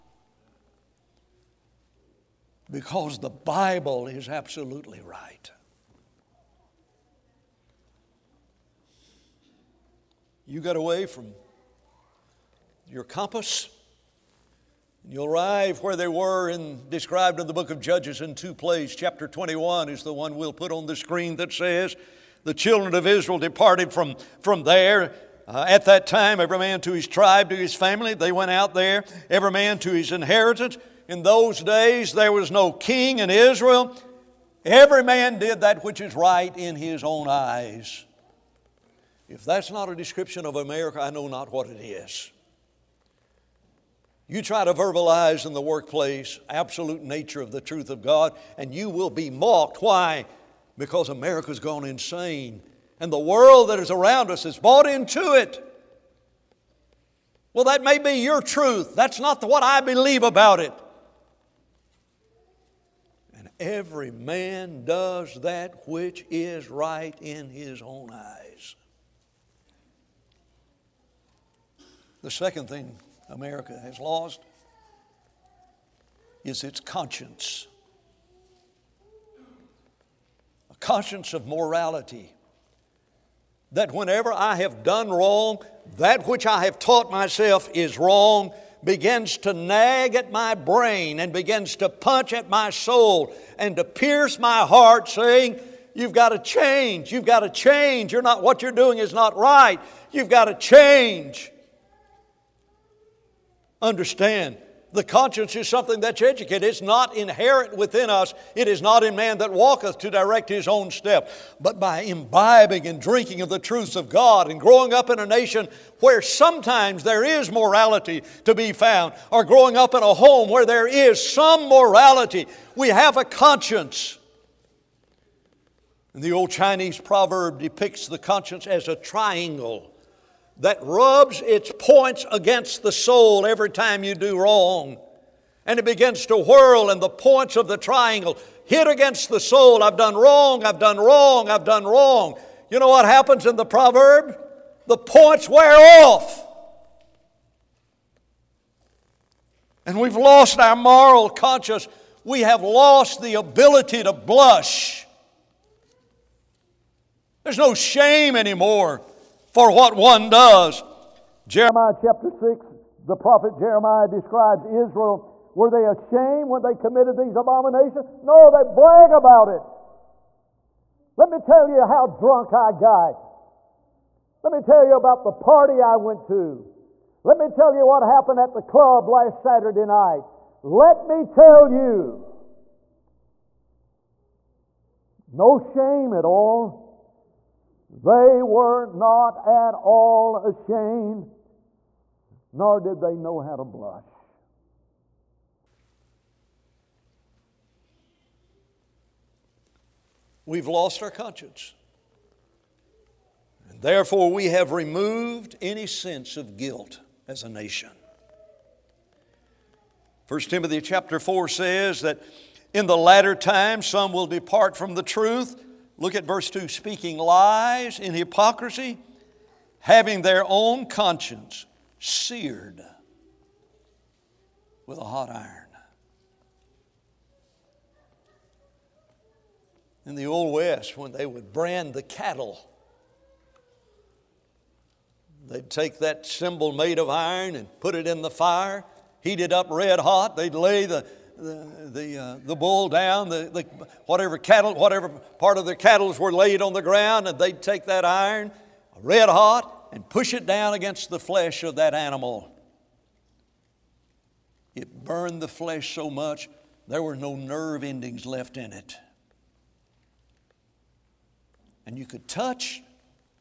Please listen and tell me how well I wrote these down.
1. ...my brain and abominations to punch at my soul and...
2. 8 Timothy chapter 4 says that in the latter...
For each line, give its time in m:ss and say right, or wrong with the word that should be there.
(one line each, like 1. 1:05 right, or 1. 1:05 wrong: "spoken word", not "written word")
1. 1:30 wrong: "begins", not "abominations"
2. 3:30 wrong: "1", not "8".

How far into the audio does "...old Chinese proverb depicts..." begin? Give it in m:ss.
2:06.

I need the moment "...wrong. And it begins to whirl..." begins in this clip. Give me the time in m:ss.
2:14.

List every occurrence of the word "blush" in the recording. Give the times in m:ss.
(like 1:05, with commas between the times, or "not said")
2:34, 3:13.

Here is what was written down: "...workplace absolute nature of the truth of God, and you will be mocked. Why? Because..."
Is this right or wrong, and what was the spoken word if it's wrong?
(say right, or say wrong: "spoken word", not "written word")
right.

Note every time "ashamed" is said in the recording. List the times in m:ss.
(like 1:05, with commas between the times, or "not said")
2:45, 3:10.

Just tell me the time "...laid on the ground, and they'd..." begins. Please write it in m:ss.
4:06.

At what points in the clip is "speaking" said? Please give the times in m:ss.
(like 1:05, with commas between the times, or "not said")
3:36.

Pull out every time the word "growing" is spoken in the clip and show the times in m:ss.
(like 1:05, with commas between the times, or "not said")
1:54, 1:59.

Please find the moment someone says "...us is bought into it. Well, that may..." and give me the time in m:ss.
0:54.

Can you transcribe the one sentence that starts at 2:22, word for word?
You know what happens in the proverb?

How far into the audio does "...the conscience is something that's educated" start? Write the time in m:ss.
1:44.